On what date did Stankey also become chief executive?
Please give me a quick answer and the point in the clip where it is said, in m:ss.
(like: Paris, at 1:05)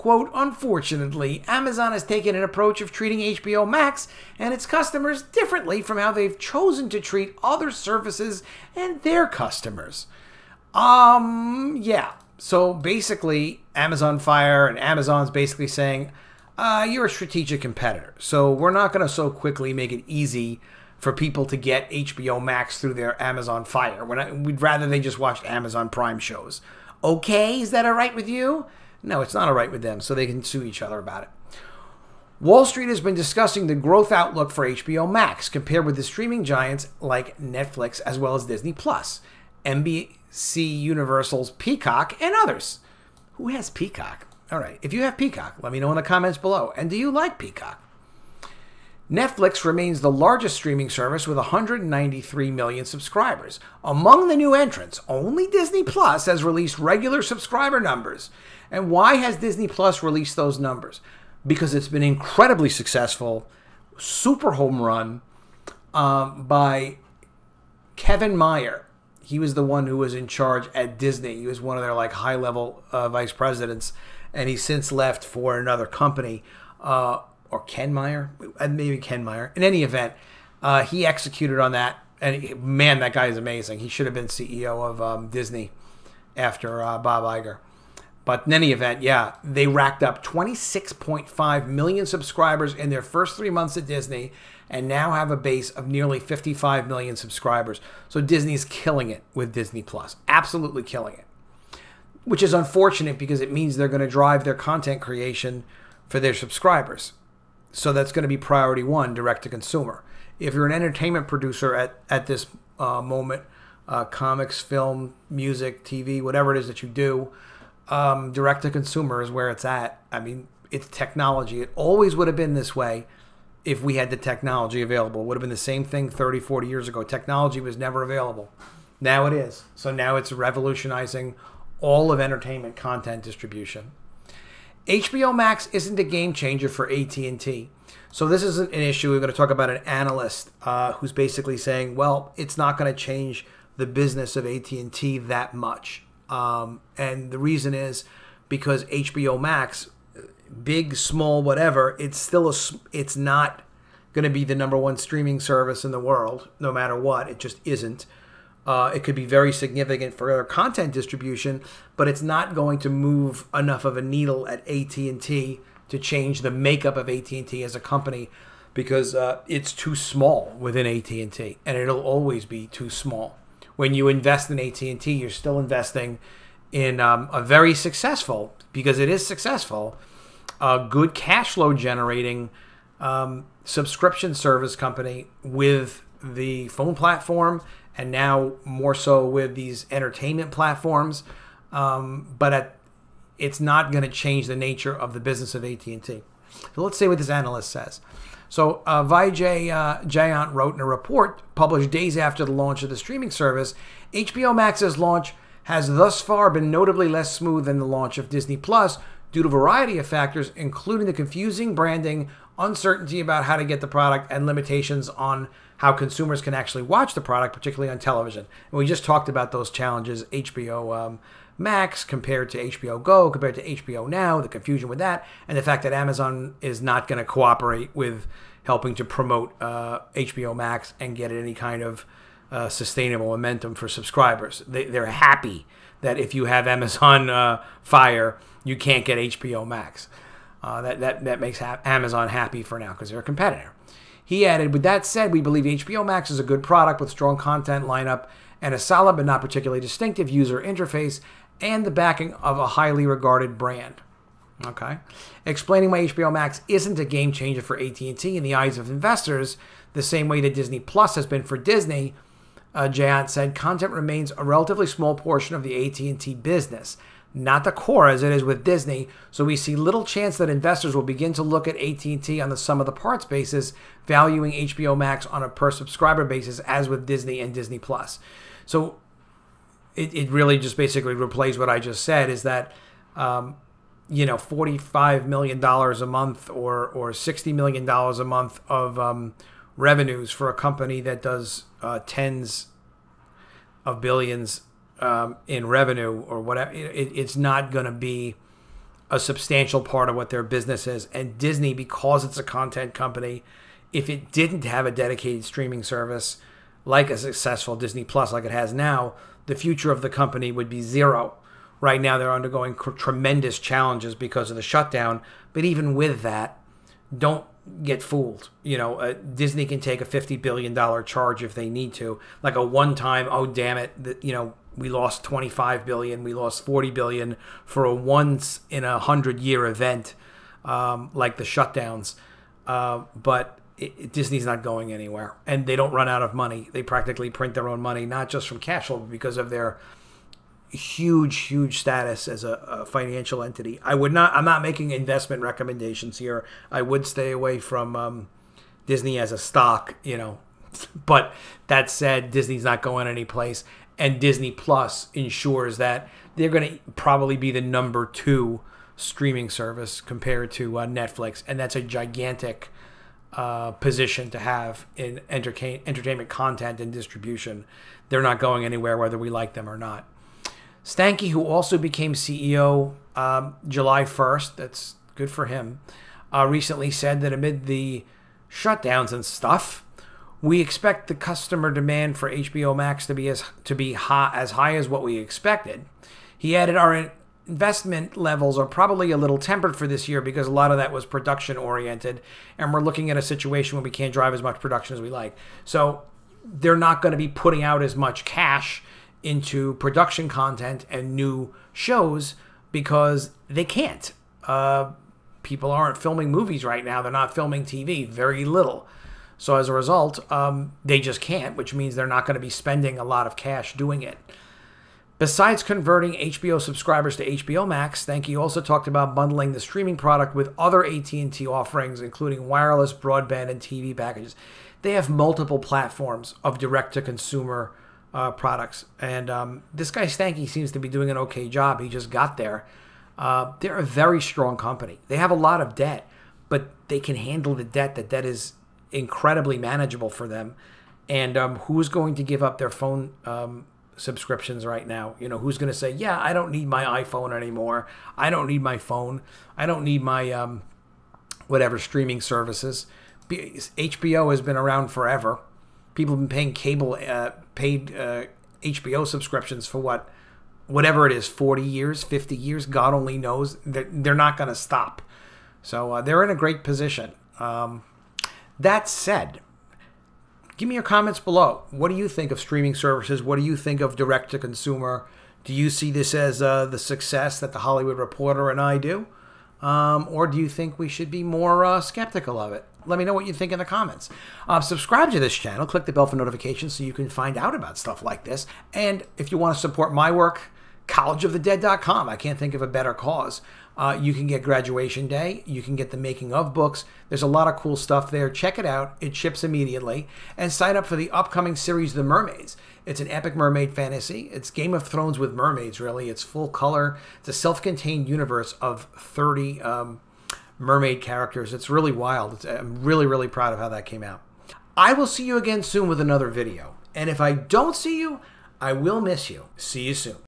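July 1st, at 6:13.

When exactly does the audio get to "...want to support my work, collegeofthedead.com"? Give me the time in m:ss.
8:09.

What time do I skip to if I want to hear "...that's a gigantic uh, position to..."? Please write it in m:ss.
6:01.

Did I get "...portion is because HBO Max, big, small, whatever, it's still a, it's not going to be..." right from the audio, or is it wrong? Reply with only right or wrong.
wrong.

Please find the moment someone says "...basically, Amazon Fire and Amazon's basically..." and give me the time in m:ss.
0:12.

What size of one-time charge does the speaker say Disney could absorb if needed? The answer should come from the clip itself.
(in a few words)
$50 billion.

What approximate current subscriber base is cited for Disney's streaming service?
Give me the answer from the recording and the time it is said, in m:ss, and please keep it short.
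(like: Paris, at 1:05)
nearly 55 million, at 1:35.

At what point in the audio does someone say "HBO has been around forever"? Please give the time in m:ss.
7:33.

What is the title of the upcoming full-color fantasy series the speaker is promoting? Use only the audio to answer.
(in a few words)
The Mermaids.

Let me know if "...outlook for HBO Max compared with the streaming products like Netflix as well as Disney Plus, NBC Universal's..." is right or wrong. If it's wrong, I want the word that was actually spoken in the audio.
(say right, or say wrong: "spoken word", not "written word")
wrong: "giants", not "products".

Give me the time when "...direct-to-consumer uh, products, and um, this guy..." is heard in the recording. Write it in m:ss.
7:06.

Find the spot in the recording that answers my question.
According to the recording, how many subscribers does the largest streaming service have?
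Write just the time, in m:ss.
0:51.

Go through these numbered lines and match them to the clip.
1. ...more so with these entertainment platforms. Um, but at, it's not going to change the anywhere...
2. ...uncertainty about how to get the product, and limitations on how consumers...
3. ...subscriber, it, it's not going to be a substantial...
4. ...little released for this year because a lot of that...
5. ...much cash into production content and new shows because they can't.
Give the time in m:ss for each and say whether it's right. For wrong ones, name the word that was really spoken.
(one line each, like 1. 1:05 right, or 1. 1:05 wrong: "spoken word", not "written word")
1. 3:08 wrong: "nature", not "anywhere"
2. 3:32 right
3. 4:56 wrong: "whatever", not "subscriber"
4. 6:29 wrong: "tempered", not "released"
5. 6:37 right.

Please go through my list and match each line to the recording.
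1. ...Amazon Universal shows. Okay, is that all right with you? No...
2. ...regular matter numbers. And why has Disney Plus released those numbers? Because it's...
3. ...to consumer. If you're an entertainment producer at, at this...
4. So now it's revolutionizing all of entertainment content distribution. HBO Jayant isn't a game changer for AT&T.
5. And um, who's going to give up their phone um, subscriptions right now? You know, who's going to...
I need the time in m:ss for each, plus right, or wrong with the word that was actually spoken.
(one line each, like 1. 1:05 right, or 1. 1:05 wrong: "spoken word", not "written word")
1. 0:25 wrong: "Prime", not "Universal"
2. 0:56 wrong: "subscriber", not "matter"
3. 1:49 right
4. 2:09 wrong: "Max", not "Jayant"
5. 7:21 right.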